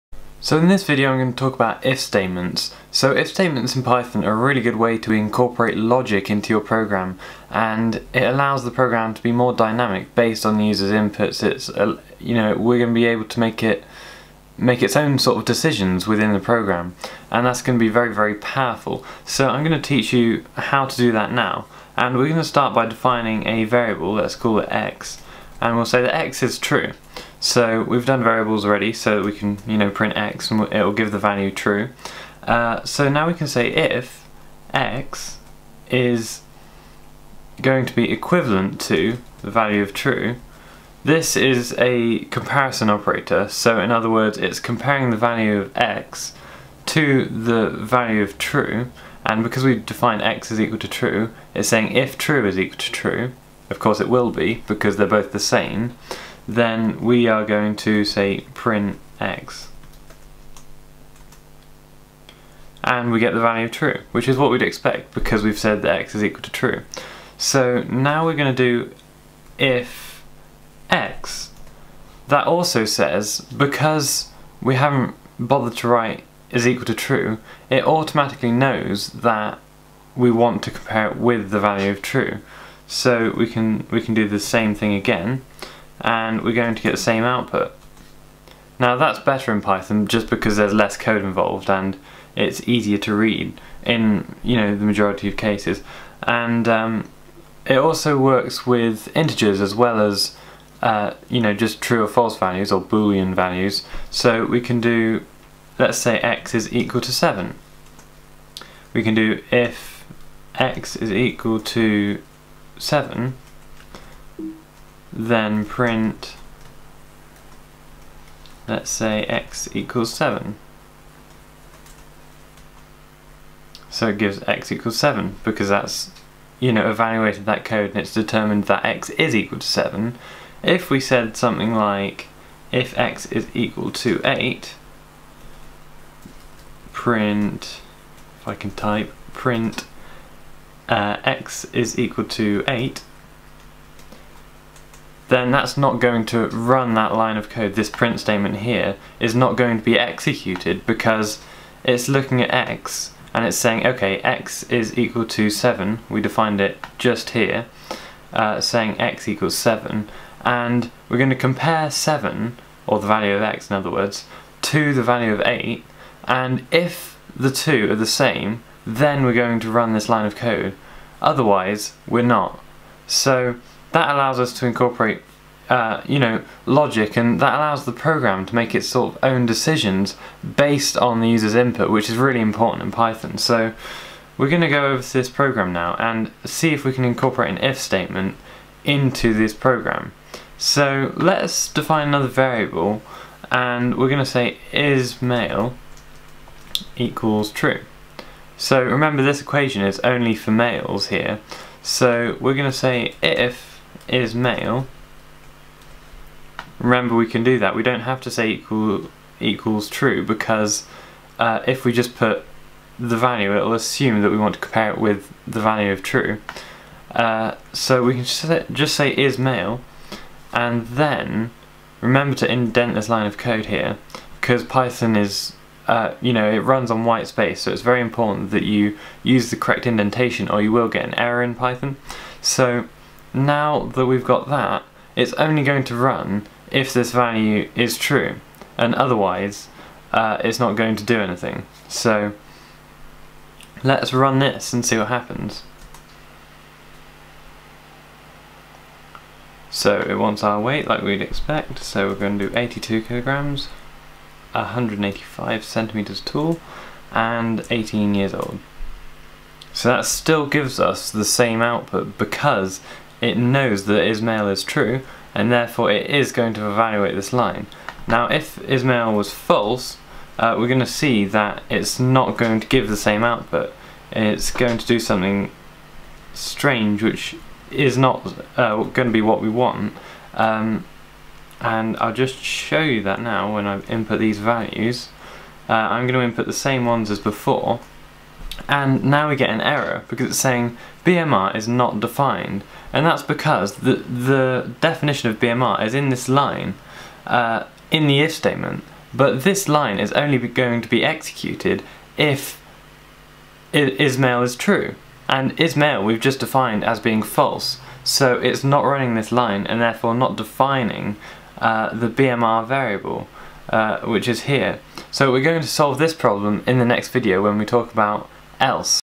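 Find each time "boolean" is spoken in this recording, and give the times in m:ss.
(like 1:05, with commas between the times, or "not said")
1:42.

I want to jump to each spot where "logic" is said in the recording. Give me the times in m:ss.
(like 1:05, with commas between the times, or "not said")
0:05, 2:56.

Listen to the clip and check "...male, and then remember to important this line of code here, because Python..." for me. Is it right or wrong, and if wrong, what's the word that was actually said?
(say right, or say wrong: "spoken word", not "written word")
wrong: "indent", not "important".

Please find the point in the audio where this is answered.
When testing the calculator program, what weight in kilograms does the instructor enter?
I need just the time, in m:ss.
4:12.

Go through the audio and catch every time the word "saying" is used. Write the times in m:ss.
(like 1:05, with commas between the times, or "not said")
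0:51, 2:33, 2:38, 4:50.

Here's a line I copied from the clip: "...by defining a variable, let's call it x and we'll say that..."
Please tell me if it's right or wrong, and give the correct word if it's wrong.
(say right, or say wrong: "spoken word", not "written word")
right.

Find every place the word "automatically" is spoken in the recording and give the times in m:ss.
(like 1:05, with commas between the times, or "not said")
1:17.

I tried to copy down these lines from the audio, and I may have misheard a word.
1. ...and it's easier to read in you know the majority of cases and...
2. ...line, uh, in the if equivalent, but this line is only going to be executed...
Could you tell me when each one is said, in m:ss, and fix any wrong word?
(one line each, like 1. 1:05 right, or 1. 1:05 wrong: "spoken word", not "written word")
1. 1:31 right
2. 4:56 wrong: "statement", not "equivalent".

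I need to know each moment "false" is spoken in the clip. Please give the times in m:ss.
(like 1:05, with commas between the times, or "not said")
1:42, 4:29, 5:07.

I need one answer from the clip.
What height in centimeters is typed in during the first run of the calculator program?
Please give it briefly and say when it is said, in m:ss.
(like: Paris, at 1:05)
185, at 4:14.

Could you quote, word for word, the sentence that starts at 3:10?
So let's define another variable, and we're going to say is male equals true.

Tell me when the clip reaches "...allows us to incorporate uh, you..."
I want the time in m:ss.
2:54.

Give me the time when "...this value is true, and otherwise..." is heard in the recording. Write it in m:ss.
3:56.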